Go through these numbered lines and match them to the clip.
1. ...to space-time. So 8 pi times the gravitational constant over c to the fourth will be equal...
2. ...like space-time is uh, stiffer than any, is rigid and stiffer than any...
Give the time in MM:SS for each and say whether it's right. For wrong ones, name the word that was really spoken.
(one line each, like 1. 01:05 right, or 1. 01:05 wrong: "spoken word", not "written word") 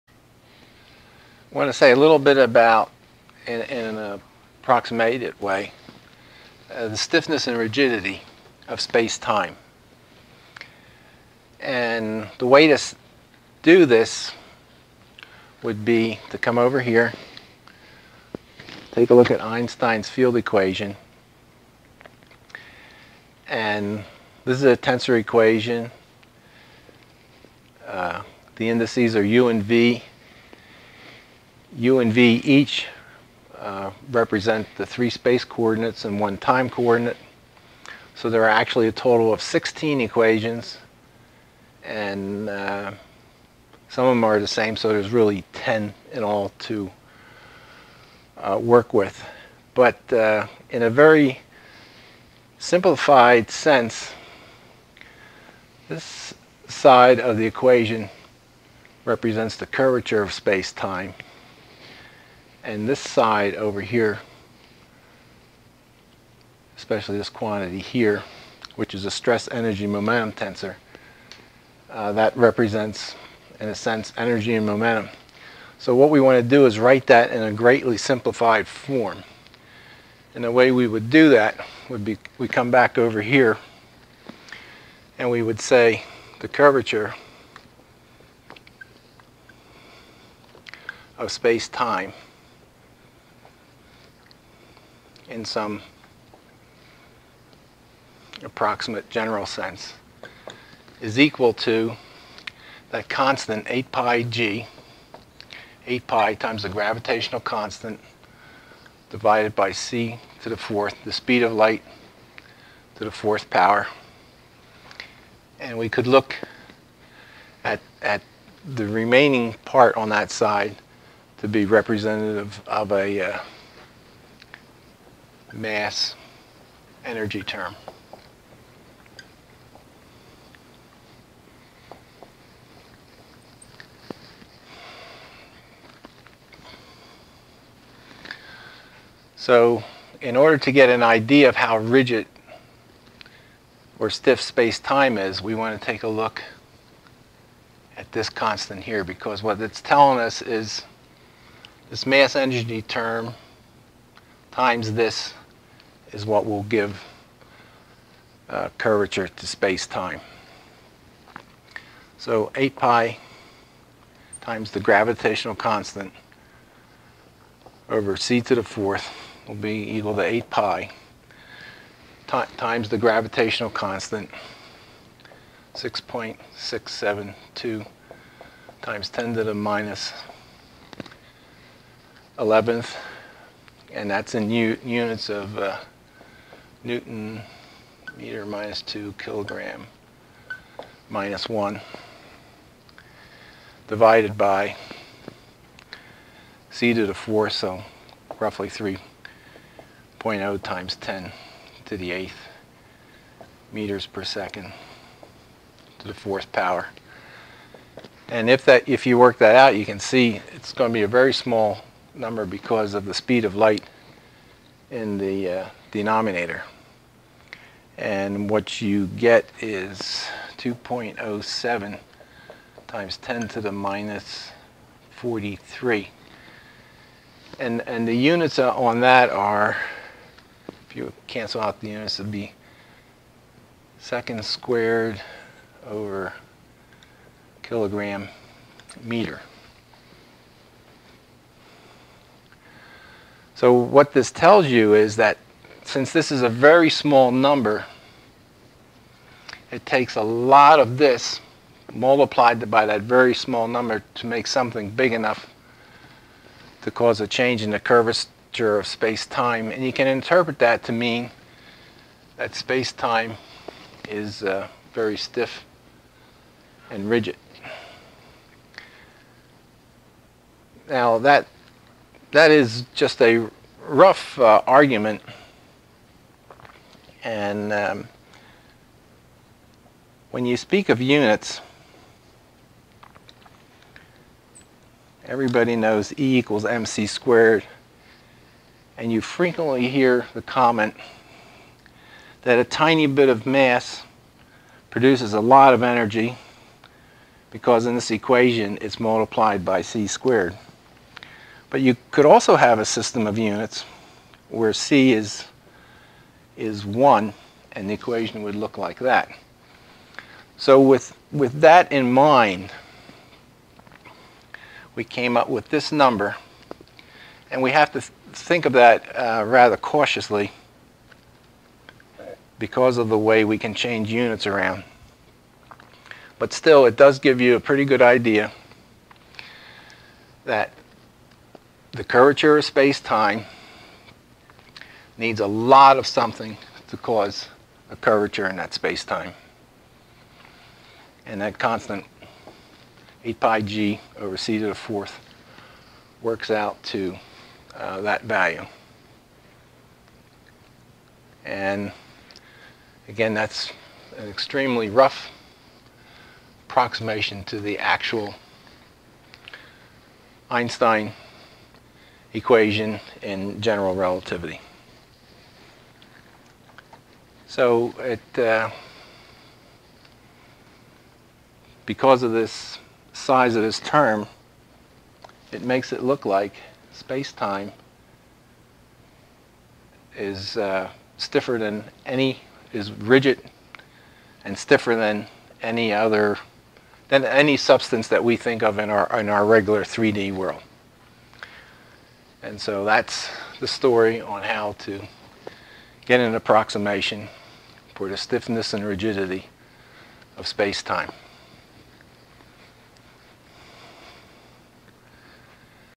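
1. 02:39 right
2. 06:16 right.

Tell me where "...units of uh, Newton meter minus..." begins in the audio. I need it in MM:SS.
03:04.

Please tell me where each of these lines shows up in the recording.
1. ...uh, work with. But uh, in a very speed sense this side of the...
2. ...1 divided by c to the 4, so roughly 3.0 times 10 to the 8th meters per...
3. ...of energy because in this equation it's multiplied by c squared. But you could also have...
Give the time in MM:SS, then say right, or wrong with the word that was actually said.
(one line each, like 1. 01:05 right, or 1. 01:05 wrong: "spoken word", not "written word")
1. 00:48 wrong: "simplified", not "speed"
2. 03:11 right
3. 04:55 right.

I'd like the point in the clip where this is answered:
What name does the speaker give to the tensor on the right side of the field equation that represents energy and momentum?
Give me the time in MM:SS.
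01:09.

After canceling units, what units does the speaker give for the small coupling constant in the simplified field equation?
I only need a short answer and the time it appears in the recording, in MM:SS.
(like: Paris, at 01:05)
second squared over kilogram meter, at 03:53.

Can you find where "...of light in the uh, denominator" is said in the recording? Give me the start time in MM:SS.
03:33.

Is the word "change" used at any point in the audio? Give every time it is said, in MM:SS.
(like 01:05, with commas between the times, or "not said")
04:17, 05:23.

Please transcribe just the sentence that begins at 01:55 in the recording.
And we could look at, at the remaining part on that side to be representative of a uh, mass energy term.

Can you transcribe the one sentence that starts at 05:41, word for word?
And that constant 8 pi g over c to the fourth works out to uh, that value.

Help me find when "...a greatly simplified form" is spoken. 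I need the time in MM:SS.
01:17.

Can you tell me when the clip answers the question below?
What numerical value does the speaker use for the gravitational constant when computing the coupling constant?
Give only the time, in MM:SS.
02:55.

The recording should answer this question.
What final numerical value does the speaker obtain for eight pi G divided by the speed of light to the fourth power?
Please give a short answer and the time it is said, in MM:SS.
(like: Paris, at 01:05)
2.07 x 10^-43, at 03:40.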